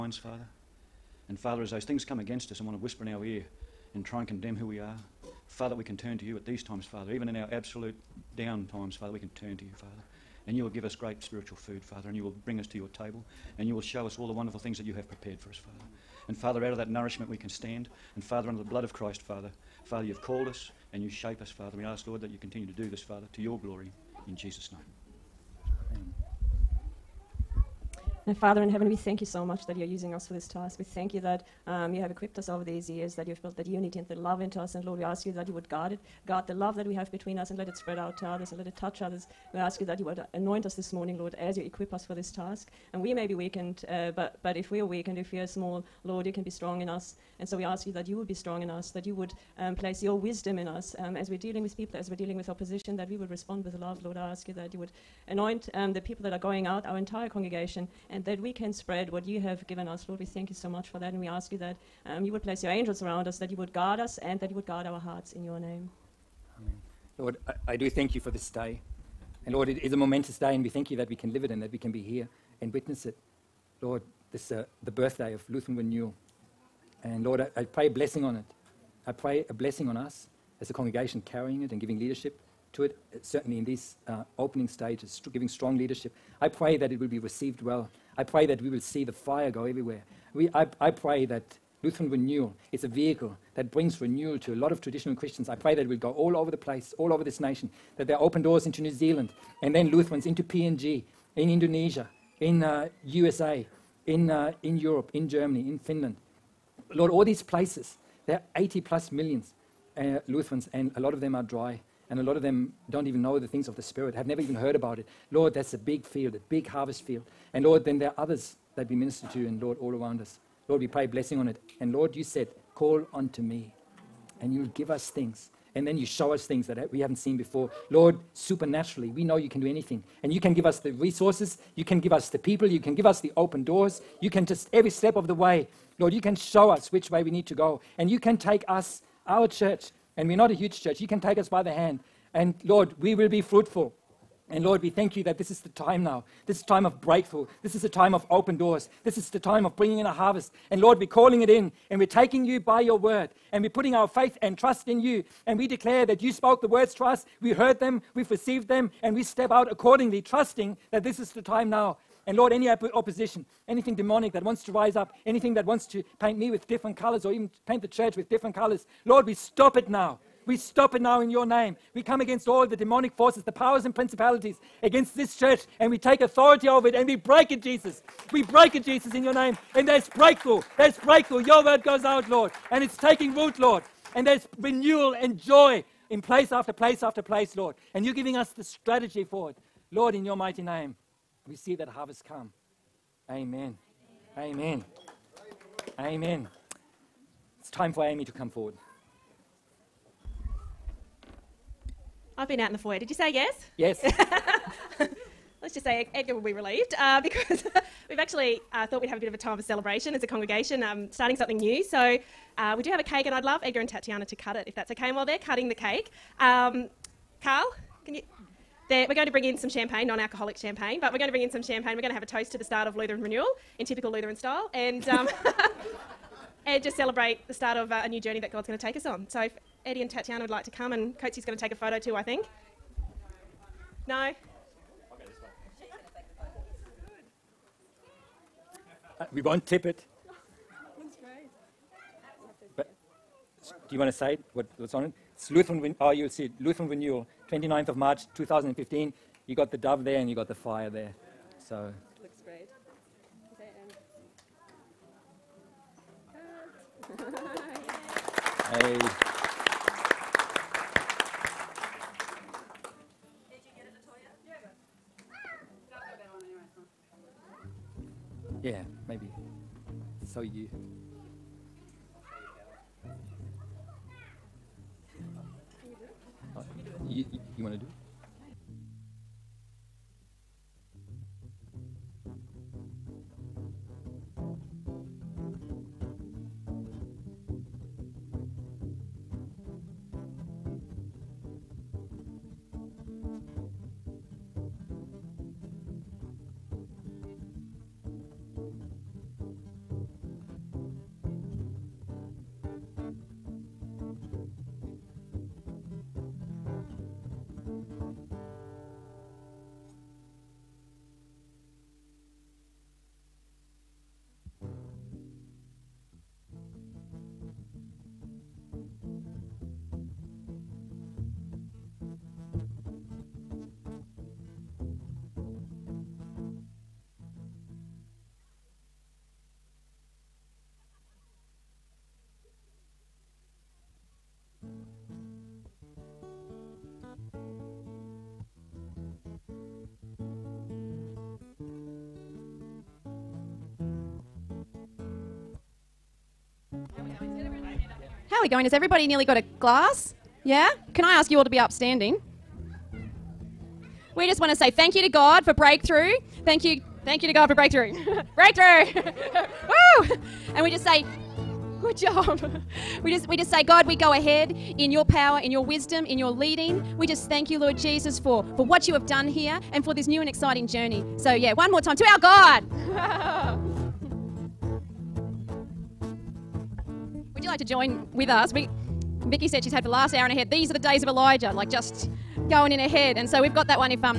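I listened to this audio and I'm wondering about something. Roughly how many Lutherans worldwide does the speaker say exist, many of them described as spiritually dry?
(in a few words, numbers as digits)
80 million.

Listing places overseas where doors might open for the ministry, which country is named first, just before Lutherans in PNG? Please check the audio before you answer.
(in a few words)
New Zealand.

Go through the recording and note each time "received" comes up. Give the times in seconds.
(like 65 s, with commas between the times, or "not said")
87 s, 158 s.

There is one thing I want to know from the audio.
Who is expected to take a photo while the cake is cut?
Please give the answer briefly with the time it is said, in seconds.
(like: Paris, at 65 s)
Coatsy, at 231 s.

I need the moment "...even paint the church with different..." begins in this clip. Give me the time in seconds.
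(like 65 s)
167 s.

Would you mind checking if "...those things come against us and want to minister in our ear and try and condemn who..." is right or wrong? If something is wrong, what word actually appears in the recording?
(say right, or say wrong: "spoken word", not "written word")
wrong: "whisper", not "minister".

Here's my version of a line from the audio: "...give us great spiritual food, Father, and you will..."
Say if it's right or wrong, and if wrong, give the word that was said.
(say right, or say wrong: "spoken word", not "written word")
right.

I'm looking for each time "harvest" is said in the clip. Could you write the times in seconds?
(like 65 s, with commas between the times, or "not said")
116 s, 150 s, 191 s.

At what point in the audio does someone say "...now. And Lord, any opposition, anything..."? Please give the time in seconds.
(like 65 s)
161 s.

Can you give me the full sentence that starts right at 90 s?
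We, I, I pray that Lutheran Renewal, it's a vehicle that brings renewal to a lot of traditional Christians.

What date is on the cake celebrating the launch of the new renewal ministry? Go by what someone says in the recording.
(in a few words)
29 March 2015.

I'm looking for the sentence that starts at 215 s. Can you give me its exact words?
And while they're cutting the cake, um, Carl, can you?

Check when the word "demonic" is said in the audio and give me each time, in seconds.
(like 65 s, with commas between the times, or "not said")
163 s, 172 s.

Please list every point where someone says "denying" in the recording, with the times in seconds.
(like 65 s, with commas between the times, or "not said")
not said.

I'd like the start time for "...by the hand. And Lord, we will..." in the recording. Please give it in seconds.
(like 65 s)
141 s.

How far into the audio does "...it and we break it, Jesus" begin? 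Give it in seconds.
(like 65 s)
176 s.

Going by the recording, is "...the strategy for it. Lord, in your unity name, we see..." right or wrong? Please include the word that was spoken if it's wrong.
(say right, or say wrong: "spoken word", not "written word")
wrong: "mighty", not "unity".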